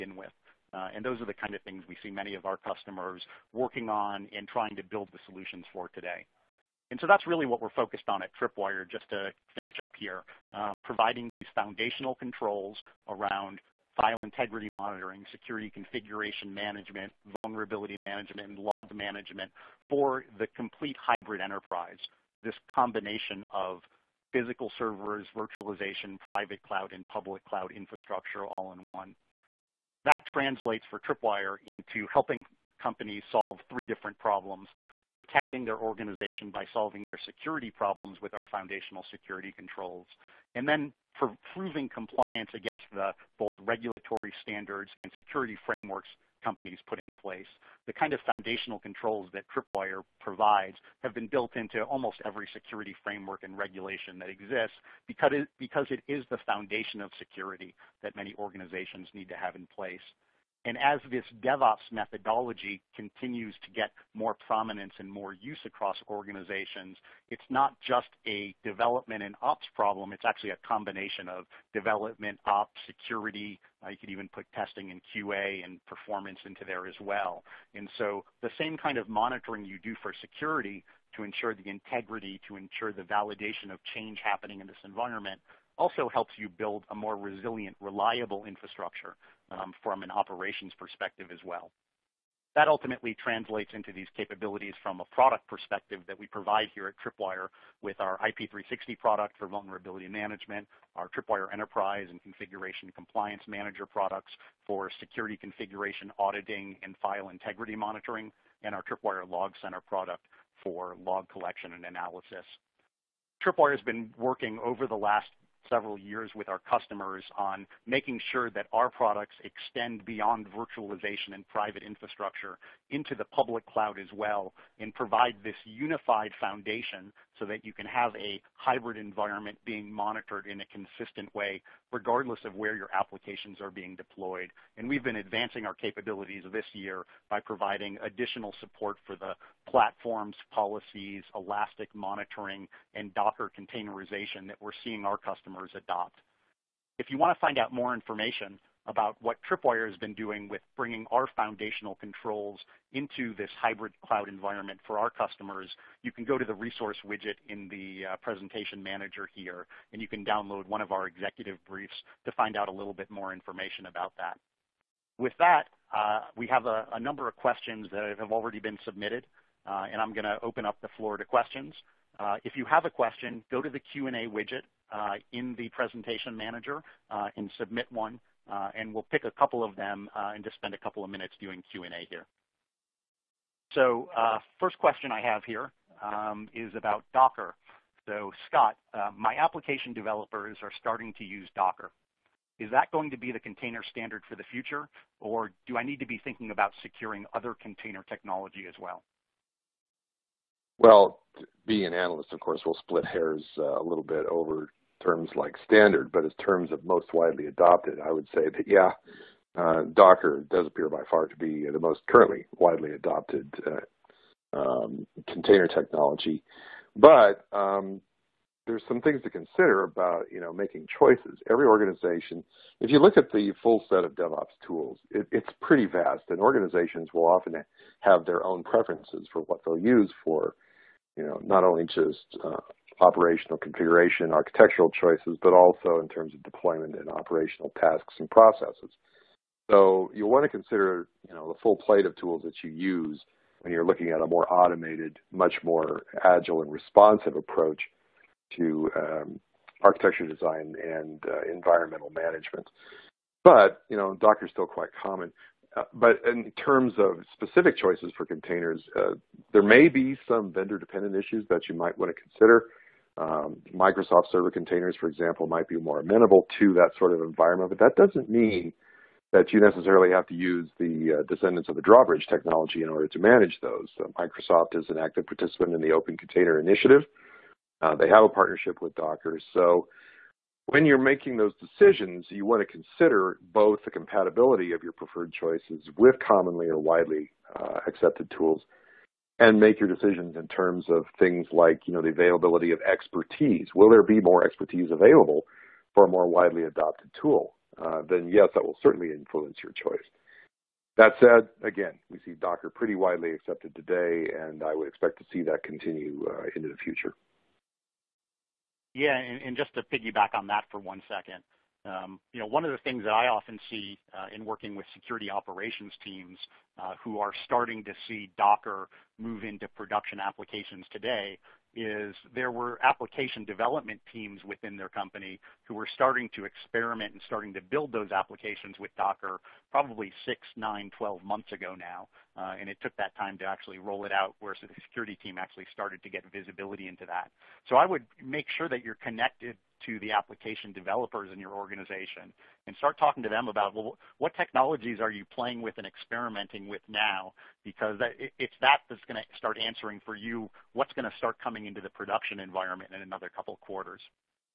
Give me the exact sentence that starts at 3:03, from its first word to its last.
So uh, first question I have here um, is about Docker.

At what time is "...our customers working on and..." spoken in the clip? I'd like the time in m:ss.
0:02.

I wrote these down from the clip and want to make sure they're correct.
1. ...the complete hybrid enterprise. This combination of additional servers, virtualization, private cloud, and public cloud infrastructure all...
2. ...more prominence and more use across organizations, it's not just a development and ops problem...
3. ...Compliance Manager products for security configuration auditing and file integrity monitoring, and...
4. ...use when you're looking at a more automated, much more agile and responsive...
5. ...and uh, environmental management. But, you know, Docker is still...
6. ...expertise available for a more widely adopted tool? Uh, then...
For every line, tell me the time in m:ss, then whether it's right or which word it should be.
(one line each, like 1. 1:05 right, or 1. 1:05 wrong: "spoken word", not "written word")
1. 0:20 wrong: "physical", not "additional"
2. 1:04 right
3. 1:42 right
4. 4:02 right
5. 4:10 right
6. 4:54 right.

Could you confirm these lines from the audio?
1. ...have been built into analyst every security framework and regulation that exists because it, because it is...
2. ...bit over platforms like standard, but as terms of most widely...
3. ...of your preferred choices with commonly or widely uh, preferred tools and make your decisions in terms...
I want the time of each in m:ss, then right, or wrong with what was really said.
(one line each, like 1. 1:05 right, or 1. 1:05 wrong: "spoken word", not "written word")
1. 0:51 wrong: "almost", not "analyst"
2. 3:24 wrong: "terms", not "platforms"
3. 4:44 wrong: "accepted", not "preferred".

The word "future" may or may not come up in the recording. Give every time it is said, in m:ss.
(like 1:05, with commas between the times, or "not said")
3:14, 5:06.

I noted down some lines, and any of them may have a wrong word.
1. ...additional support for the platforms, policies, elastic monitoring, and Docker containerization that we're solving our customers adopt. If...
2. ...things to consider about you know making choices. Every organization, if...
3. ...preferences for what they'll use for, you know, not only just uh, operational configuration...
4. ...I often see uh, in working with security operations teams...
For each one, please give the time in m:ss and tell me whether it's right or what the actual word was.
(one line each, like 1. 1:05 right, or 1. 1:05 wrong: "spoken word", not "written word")
1. 2:18 wrong: "seeing", not "solving"
2. 3:39 right
3. 3:48 right
4. 5:13 right.